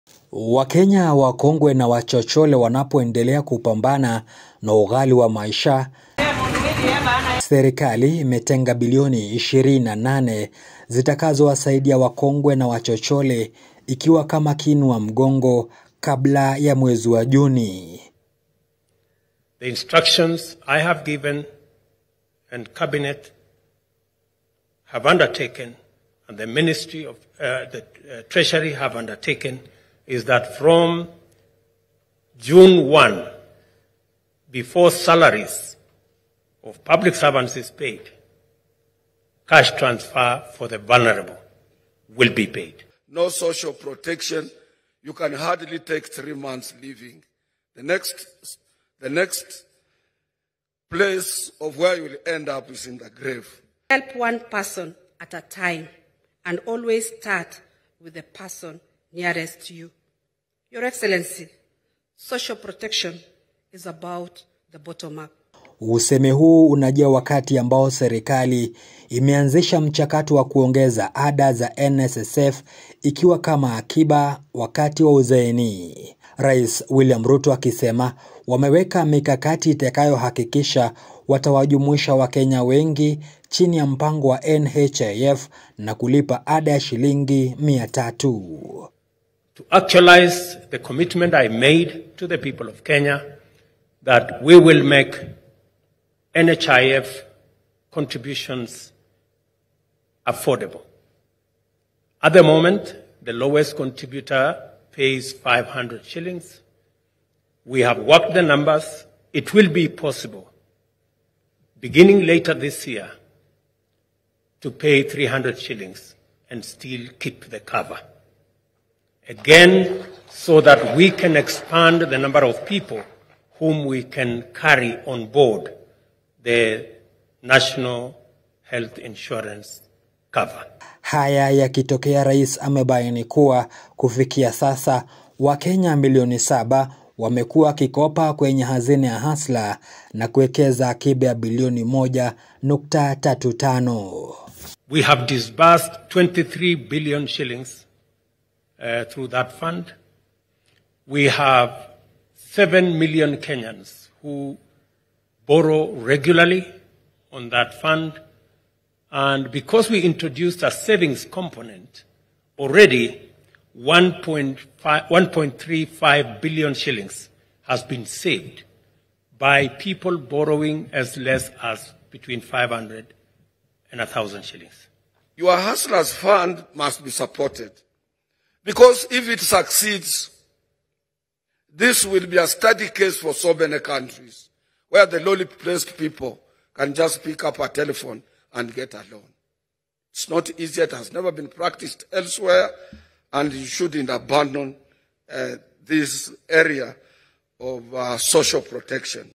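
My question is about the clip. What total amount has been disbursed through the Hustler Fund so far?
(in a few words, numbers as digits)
23 billion shillings.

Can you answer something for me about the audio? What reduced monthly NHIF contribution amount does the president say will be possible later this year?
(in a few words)
300 shillings.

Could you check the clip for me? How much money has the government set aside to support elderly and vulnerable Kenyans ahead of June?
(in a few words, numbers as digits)
28 billion.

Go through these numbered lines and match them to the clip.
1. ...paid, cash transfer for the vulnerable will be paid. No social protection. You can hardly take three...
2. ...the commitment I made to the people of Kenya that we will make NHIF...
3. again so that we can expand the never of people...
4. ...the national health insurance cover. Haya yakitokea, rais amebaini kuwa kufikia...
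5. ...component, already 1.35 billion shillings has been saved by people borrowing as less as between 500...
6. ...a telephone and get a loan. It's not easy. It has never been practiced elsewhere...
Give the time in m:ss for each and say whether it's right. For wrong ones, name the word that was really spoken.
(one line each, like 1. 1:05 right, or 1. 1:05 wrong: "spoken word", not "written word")
1. 0:37 right
2. 1:30 right
3. 1:59 wrong: "number", not "never"
4. 2:06 right
5. 2:41 right
6. 3:07 right.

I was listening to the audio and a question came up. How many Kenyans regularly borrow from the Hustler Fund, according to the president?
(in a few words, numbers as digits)
7 million.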